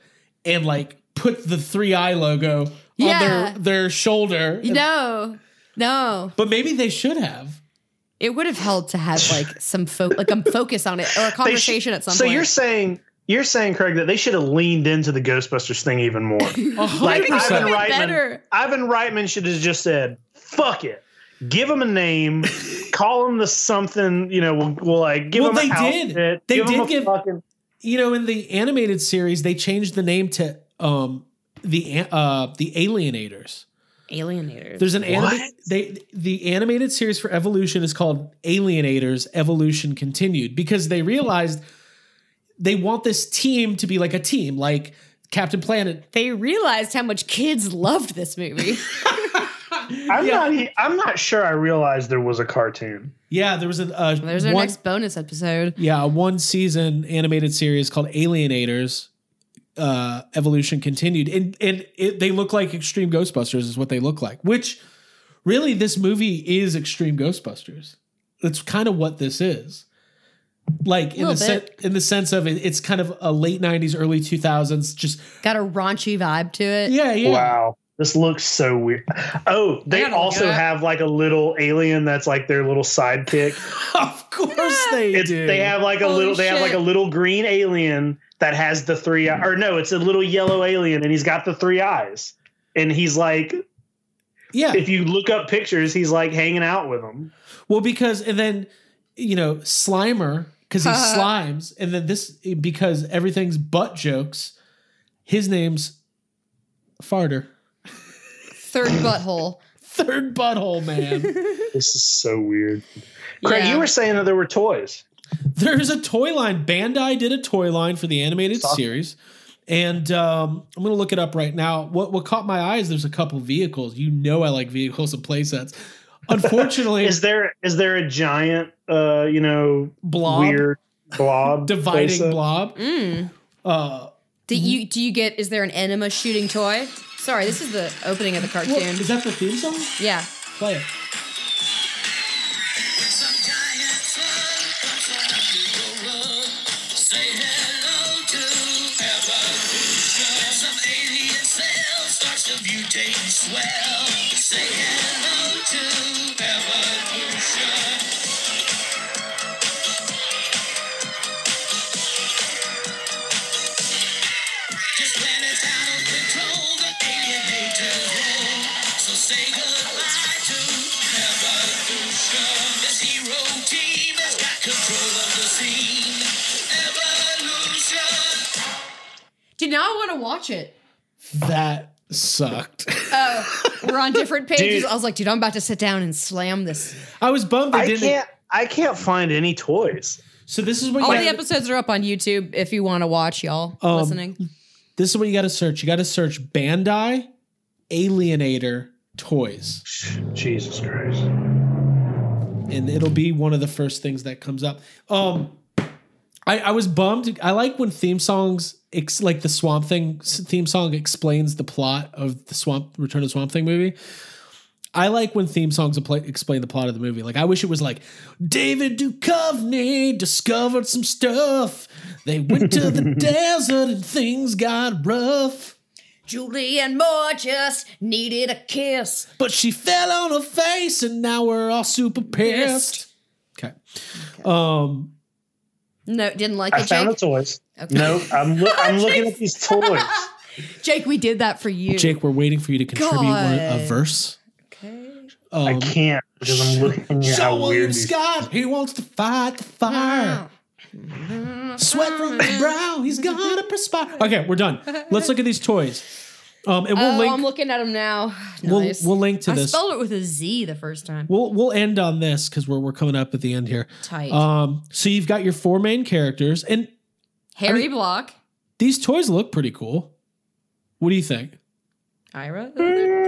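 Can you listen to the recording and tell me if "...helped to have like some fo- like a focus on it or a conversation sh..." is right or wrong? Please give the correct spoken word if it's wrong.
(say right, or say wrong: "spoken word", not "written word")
right.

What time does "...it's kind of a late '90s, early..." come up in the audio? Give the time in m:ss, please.
1:12.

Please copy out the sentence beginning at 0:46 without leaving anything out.
They realized how much kids loved this movie.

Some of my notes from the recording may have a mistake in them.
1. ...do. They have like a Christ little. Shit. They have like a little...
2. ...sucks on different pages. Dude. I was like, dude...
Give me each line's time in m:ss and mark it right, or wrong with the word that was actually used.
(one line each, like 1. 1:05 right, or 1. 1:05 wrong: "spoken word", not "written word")
1. 1:25 wrong: "Holy", not "Christ"
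2. 3:02 right.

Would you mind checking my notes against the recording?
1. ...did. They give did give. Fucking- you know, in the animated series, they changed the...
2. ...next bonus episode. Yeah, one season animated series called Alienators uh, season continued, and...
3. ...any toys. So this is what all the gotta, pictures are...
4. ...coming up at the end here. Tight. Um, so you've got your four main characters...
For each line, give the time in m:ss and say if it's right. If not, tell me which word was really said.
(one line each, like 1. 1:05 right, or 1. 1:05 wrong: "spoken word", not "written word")
1. 0:26 right
2. 0:54 wrong: "evolution", not "season"
3. 3:09 wrong: "episodes", not "pictures"
4. 4:22 right.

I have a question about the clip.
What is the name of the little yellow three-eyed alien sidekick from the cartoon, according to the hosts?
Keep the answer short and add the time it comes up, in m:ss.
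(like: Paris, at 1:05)
Farter, at 1:47.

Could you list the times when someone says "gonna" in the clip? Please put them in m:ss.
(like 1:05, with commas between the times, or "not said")
2:00, 4:13.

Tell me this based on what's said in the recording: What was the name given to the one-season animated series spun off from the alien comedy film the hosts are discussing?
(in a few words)
Alienators: Evolution Continued.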